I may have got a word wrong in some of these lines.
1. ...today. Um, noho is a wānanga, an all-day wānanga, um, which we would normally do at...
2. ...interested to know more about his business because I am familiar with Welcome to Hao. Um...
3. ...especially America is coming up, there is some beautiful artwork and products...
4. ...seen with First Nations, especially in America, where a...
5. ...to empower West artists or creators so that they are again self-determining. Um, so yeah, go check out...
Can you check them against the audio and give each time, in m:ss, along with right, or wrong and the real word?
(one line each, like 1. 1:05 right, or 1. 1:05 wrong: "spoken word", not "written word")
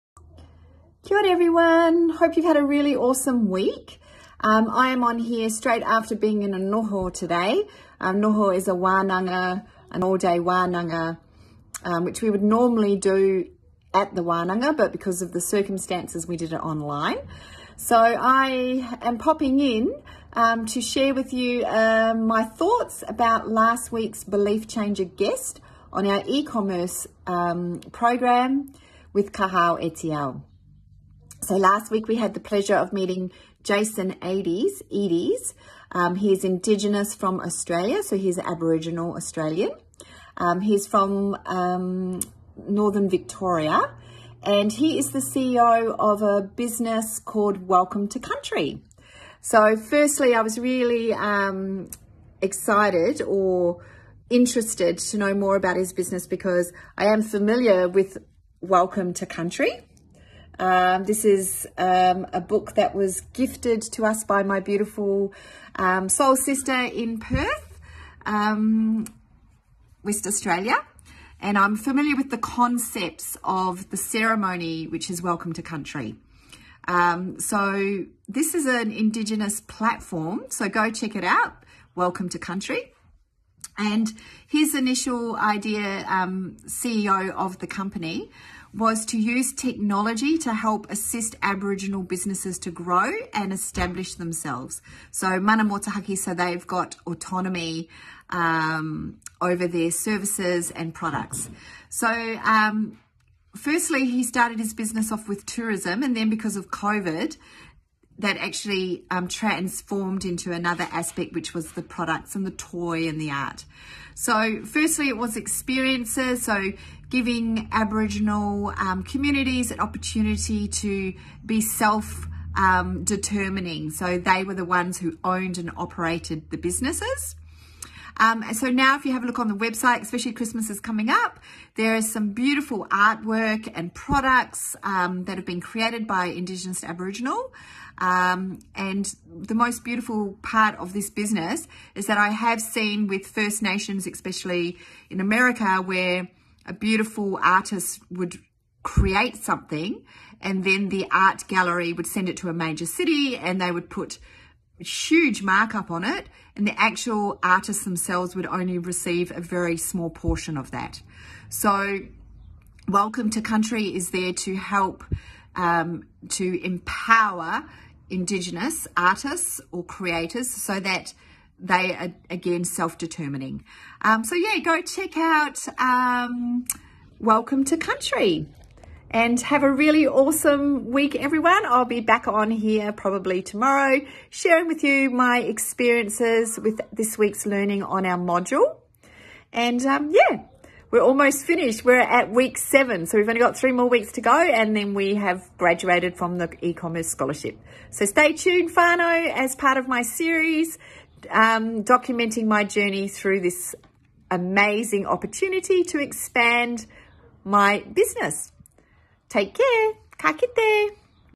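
1. 0:07 right
2. 0:54 wrong: "Country", not "Hao"
3. 2:10 wrong: "Christmas", not "America"
4. 2:22 right
5. 2:46 wrong: "Indigenous", not "West".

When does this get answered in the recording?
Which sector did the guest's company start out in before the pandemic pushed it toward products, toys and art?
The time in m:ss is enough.
1:45.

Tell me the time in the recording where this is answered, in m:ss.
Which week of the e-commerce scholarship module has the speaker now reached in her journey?
3:12.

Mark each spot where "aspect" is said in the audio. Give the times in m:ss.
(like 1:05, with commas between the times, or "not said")
1:50.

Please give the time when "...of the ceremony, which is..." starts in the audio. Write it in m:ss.
1:13.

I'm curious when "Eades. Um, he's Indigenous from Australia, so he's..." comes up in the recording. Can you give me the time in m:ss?
0:34.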